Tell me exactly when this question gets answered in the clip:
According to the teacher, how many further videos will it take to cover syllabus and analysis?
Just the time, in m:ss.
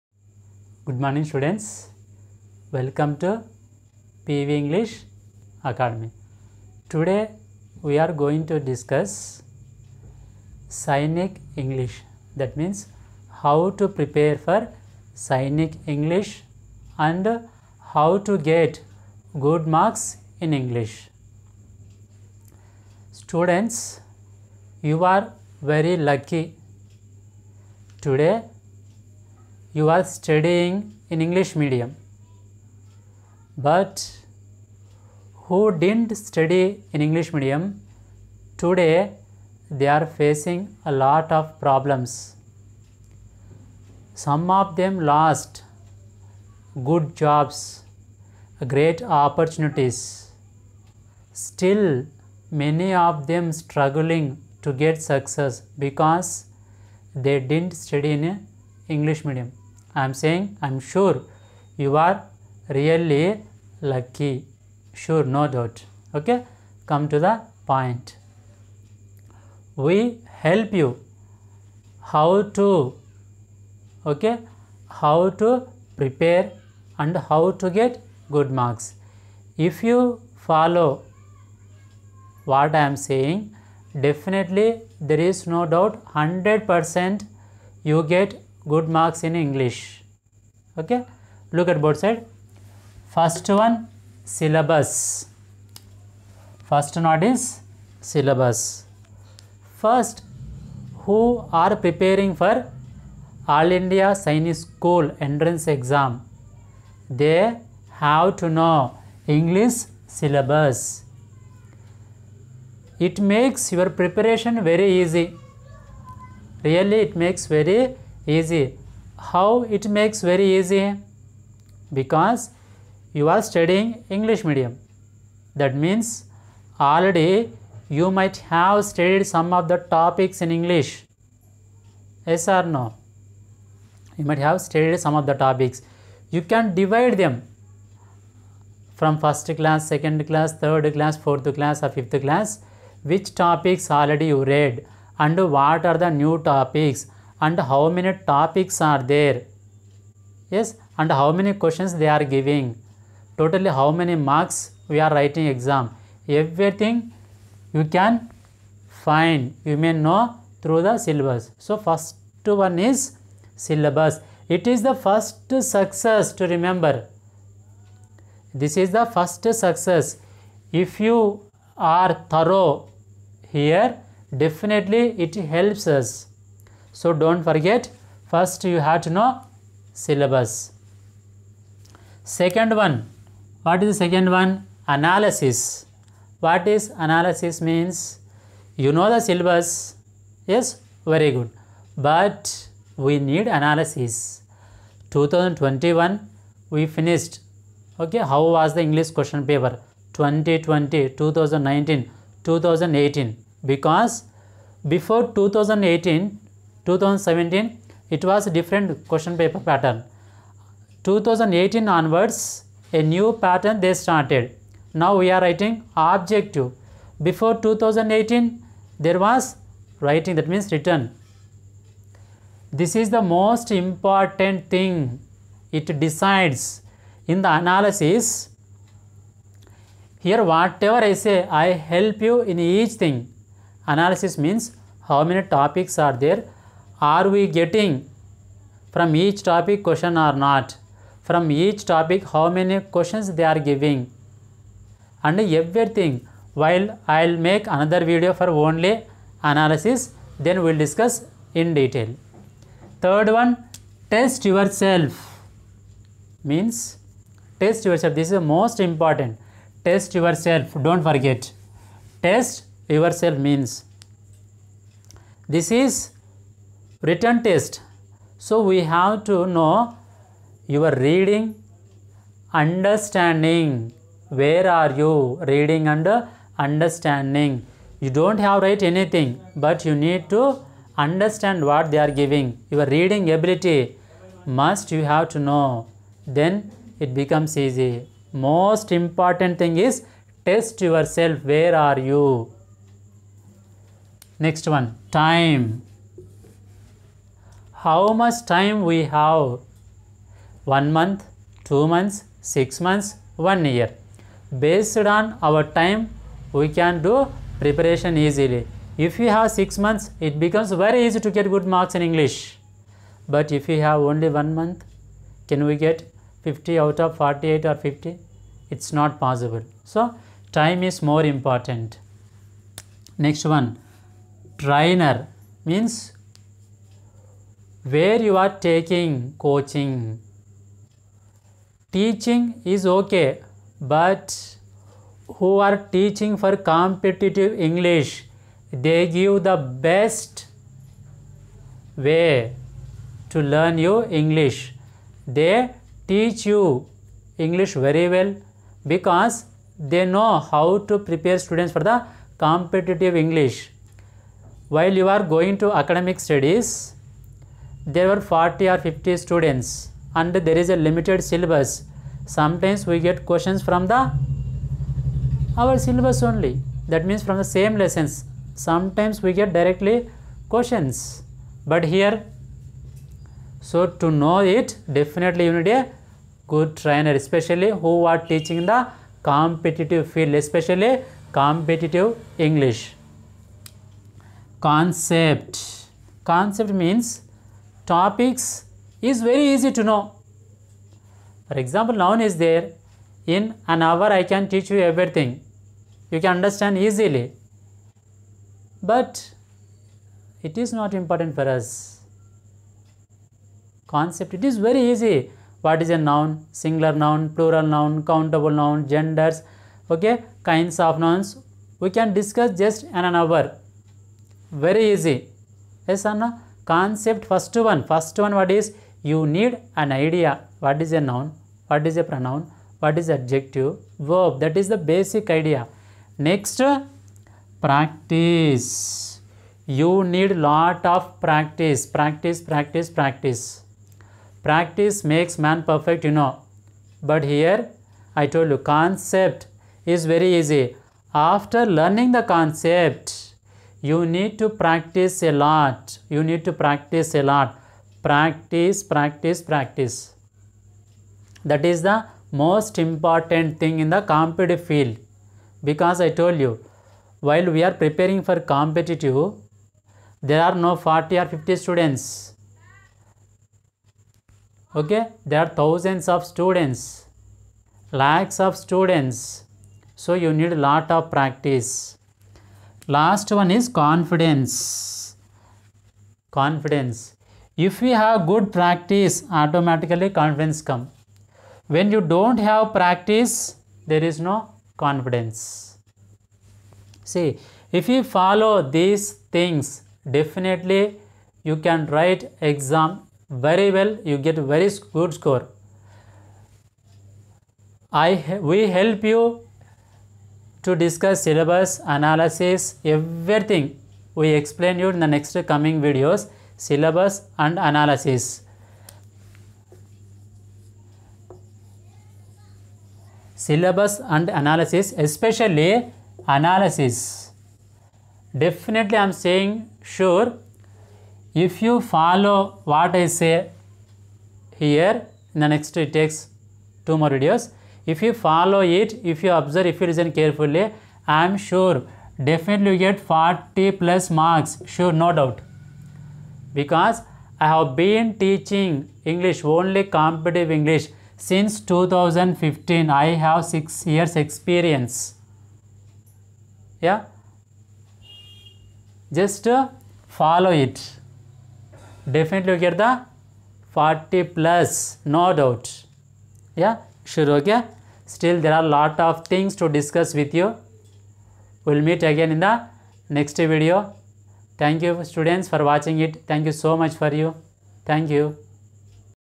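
8:46.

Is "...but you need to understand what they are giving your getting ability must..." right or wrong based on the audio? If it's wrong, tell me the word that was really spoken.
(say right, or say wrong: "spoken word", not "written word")
wrong: "reading", not "getting".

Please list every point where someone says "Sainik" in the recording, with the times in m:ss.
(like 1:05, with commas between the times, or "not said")
0:10, 0:15, 1:44.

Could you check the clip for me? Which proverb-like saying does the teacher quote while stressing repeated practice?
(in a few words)
Practice makes man perfect.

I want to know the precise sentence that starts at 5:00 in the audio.
1 month, 2 months, 6 months, 1 year.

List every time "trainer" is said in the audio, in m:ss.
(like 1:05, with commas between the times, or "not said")
5:24, 6:16.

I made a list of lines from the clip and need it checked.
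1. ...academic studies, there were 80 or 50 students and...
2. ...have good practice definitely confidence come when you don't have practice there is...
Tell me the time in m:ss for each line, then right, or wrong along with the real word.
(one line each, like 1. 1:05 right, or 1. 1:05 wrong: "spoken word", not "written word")
1. 5:55 wrong: "40", not "80"
2. 7:57 wrong: "automatically", not "definitely".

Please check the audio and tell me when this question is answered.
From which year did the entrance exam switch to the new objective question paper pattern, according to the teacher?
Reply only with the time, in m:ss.
3:31.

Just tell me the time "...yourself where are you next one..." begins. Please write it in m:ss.
4:50.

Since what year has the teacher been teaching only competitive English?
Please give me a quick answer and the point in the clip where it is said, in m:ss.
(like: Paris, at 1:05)
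2015, at 9:01.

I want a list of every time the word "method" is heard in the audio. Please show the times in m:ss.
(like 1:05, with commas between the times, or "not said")
not said.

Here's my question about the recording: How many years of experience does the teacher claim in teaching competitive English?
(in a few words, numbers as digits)
6 years.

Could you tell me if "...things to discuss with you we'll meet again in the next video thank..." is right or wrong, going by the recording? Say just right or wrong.
right.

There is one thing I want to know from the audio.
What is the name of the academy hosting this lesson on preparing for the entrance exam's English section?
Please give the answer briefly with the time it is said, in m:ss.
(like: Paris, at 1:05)
PV English Academy, at 0:04.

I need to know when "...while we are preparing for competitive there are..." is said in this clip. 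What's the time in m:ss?
7:37.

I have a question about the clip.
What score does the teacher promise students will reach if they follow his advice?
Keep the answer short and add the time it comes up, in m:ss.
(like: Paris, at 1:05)
40 plus marks, at 8:52.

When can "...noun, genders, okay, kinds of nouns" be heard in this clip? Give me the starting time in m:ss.
6:48.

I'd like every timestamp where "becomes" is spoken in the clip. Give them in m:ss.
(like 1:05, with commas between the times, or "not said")
4:47, 5:10.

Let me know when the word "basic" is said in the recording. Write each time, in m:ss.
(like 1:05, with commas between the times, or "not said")
7:04.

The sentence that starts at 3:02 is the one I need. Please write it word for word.
Second one, what is the second one?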